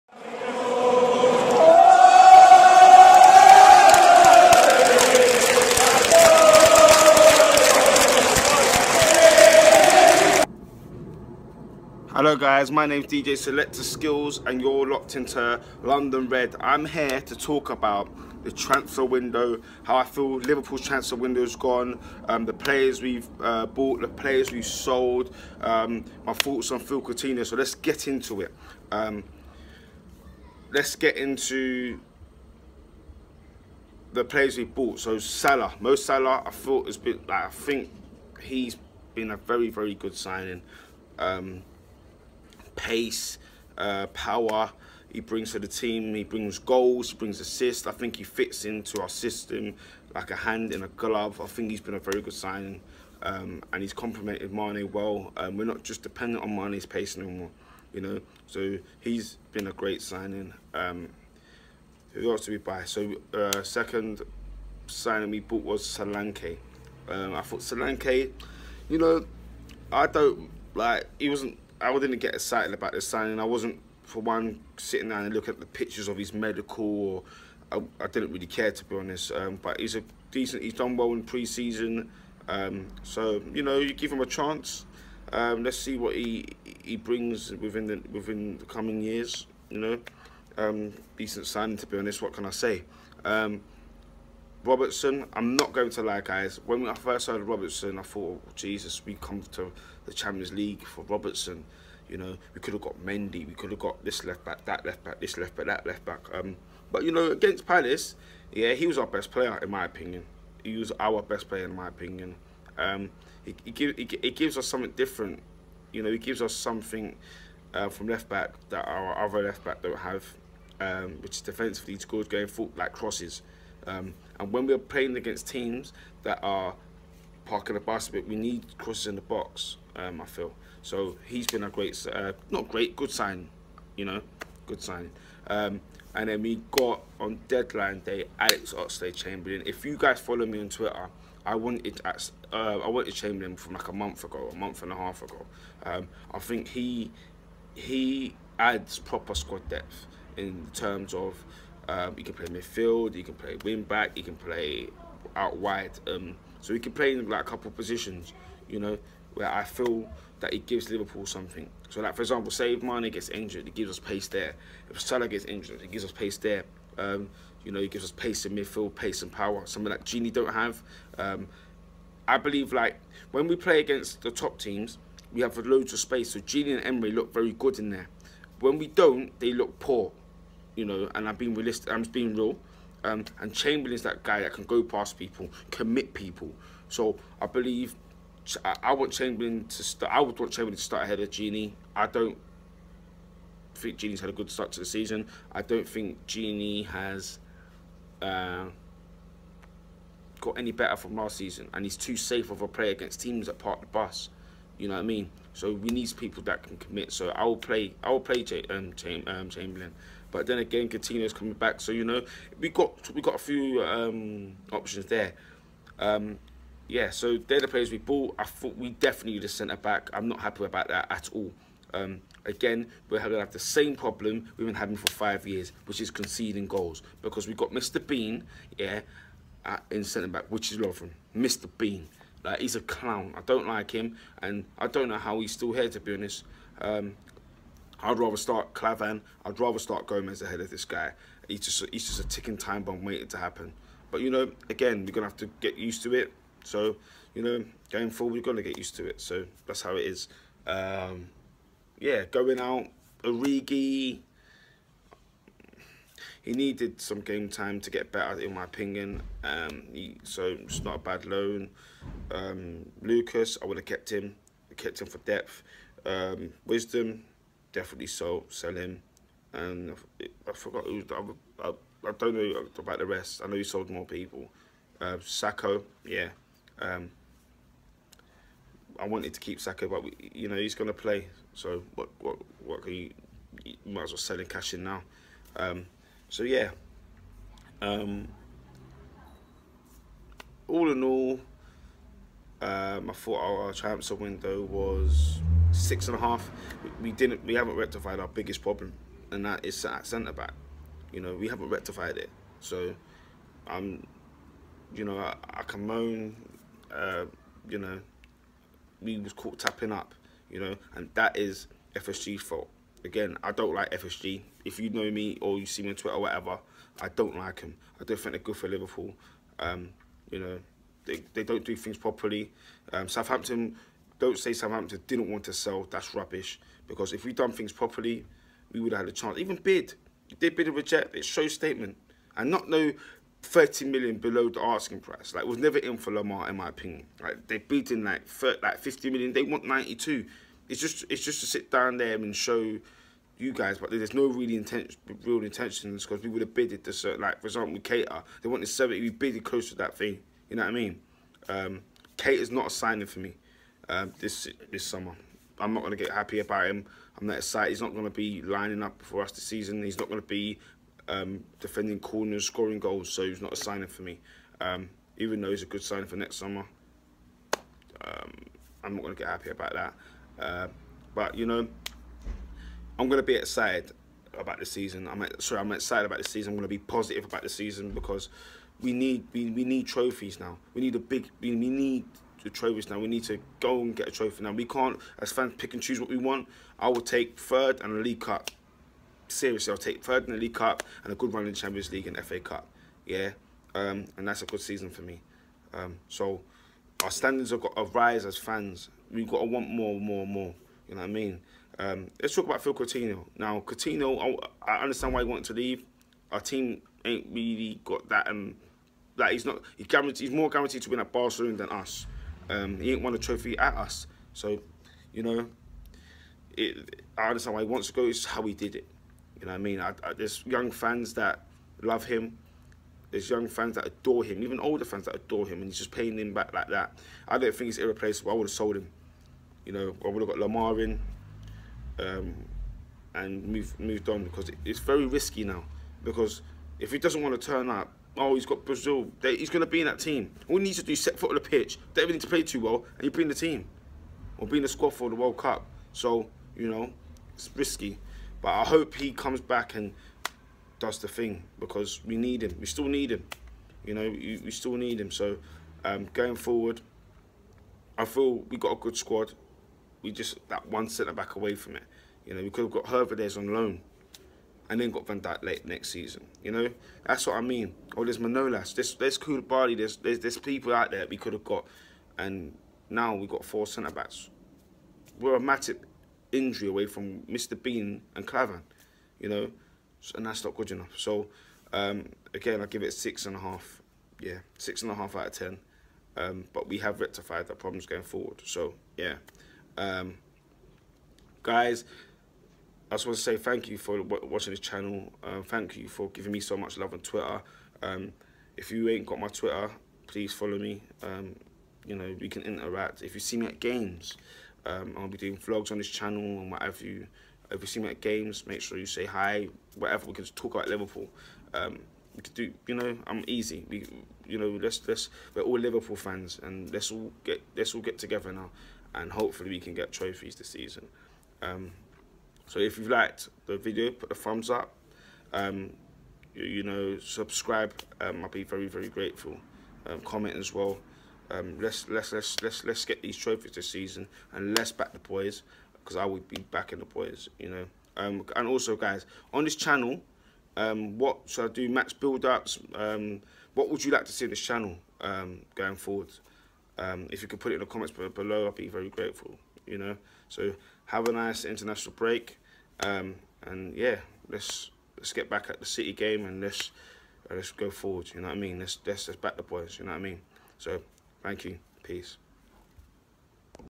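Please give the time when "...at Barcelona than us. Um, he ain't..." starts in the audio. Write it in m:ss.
6:50.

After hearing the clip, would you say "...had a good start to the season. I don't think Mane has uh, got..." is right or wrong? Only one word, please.
wrong.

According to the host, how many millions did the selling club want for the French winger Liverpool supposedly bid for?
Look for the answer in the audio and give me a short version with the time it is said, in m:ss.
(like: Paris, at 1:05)
92 million, at 5:39.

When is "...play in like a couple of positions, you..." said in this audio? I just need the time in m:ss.
2:36.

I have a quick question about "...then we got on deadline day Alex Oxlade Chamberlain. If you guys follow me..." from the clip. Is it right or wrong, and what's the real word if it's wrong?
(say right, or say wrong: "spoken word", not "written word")
right.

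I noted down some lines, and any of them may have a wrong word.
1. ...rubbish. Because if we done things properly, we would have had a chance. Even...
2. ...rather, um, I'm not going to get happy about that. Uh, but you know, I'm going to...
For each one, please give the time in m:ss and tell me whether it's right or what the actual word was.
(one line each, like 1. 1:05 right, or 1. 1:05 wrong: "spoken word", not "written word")
1. 5:26 right
2. 6:06 wrong: "summer", not "rather".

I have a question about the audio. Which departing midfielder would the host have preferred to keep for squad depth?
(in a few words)
Lucas.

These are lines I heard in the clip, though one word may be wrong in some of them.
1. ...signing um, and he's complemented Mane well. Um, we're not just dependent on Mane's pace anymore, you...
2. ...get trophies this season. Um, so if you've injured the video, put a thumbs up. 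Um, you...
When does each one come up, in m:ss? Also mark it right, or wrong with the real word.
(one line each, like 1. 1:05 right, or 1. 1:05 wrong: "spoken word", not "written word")
1. 0:52 right
2. 8:39 wrong: "liked", not "injured".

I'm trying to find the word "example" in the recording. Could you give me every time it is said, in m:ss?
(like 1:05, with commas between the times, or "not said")
2:42, 5:47.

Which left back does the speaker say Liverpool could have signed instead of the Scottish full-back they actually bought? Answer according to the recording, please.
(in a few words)
Mendy.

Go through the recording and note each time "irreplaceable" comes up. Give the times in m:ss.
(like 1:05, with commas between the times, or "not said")
7:07.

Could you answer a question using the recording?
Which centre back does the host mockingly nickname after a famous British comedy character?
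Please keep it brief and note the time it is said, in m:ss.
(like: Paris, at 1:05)
Lovren, at 3:50.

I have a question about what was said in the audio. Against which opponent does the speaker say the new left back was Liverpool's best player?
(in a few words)
Palace.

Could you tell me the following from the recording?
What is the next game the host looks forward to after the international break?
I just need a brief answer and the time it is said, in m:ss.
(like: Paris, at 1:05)
City game, at 9:15.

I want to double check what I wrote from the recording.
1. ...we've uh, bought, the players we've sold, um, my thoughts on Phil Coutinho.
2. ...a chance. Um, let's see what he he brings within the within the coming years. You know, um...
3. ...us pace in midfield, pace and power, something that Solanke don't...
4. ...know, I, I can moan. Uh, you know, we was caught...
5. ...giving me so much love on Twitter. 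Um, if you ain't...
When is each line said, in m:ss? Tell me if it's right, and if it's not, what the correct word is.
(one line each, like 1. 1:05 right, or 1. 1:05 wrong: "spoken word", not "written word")
1. 0:23 right
2. 1:24 right
3. 2:48 wrong: "Gini", not "Solanke"
4. 5:05 right
5. 8:16 right.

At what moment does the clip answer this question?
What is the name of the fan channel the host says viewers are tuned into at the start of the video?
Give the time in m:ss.
0:15.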